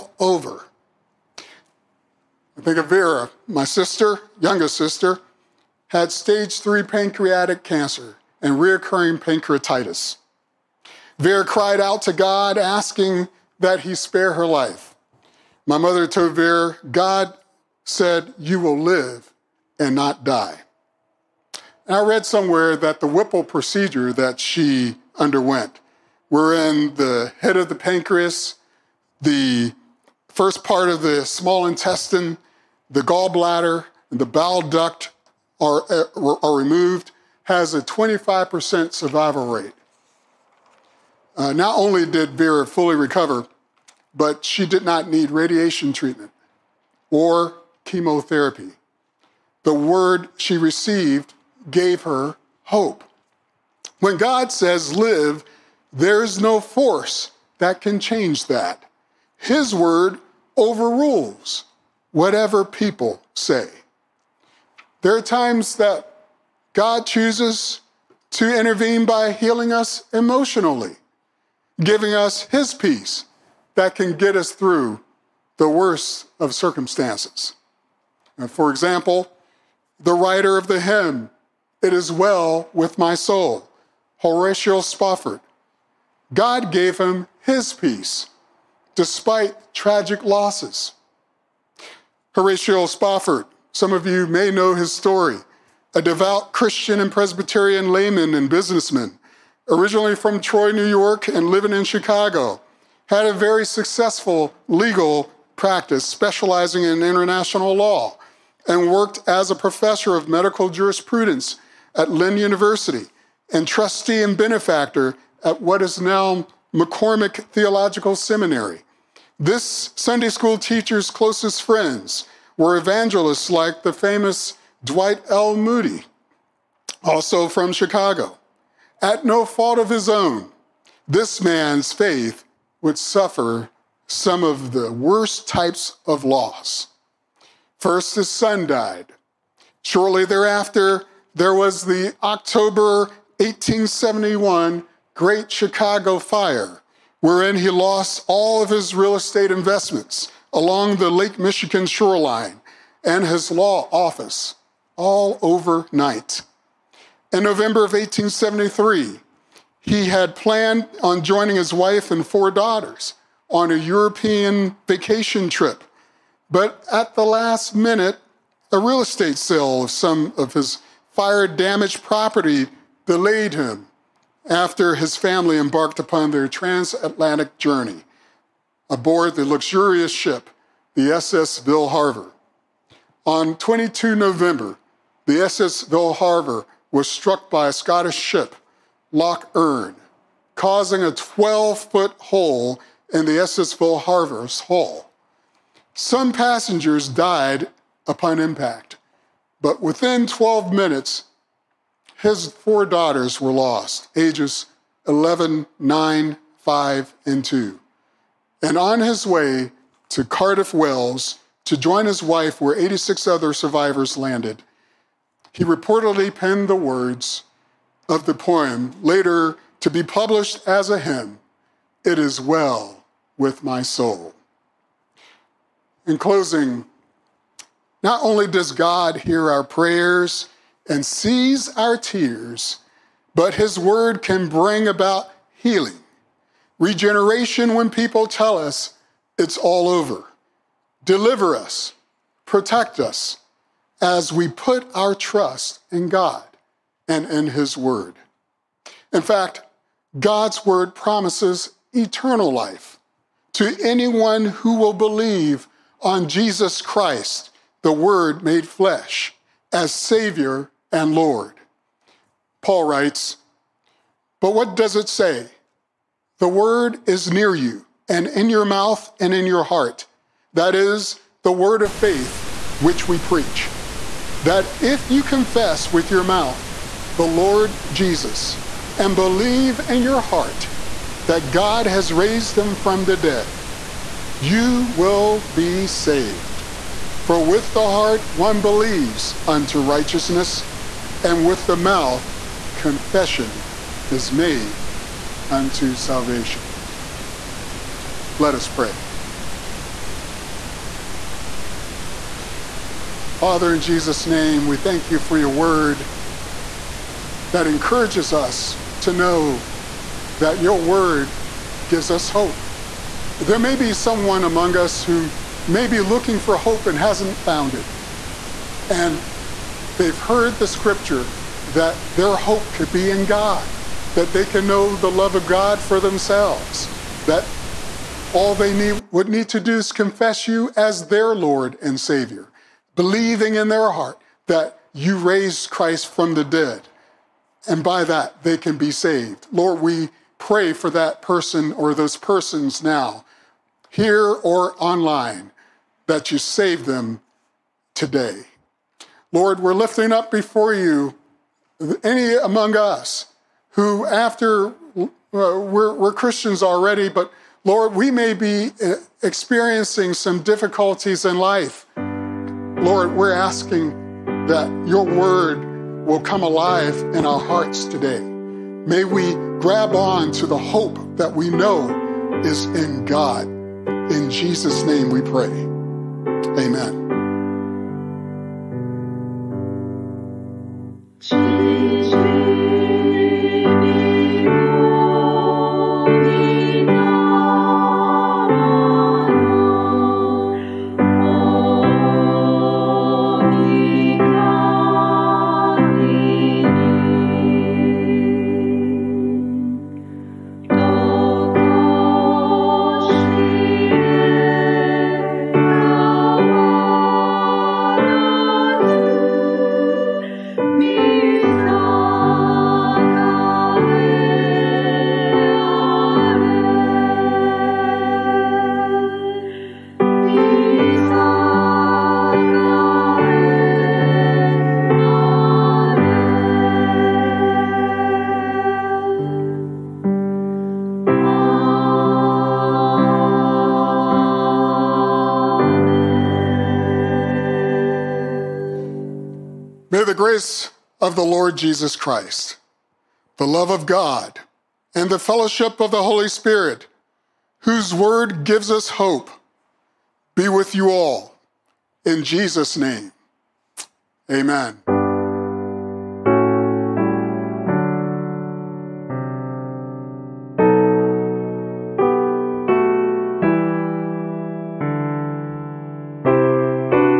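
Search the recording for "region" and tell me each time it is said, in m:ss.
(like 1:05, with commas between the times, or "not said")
not said.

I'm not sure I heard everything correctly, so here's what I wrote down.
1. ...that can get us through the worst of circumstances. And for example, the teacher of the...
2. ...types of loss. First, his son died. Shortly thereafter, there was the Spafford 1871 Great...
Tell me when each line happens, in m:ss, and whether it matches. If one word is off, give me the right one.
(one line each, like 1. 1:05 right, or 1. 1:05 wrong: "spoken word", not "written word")
1. 1:13 wrong: "writer", not "teacher"
2. 2:15 wrong: "October", not "Spafford".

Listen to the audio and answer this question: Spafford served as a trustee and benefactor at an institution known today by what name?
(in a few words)
McCormick Theological Seminary.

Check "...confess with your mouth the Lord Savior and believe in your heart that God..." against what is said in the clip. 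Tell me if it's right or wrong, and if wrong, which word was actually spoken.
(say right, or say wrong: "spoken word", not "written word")
wrong: "Jesus", not "Savior".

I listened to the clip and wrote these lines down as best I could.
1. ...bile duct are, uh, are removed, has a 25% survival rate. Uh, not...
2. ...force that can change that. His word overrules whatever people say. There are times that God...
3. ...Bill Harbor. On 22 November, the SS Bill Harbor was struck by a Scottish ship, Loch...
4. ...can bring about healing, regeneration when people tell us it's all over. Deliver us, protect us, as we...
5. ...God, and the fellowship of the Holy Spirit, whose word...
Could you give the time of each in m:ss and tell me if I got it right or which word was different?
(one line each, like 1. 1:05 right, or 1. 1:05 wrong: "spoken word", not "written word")
1. 0:34 right
2. 0:56 right
3. 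3:01 right
4. 3:54 right
5. 7:23 right.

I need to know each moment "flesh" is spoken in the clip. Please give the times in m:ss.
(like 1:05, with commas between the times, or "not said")
4:18.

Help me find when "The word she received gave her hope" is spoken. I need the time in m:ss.
0:49.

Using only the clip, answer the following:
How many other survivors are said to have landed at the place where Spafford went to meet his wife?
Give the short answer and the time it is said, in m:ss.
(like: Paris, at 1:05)
86, at 3:32.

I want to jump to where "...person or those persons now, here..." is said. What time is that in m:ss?
5:41.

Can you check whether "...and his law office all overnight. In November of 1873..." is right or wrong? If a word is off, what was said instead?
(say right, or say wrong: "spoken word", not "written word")
right.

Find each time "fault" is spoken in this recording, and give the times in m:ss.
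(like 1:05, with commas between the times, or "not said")
2:09.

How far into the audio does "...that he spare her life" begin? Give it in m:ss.
0:13.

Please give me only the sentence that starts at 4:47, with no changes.
For with the heart one believes unto righteousness, and with the mouth confession is made unto salvation.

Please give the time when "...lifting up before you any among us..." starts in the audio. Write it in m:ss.
5:49.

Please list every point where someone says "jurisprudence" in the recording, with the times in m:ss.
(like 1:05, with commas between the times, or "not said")
1:50.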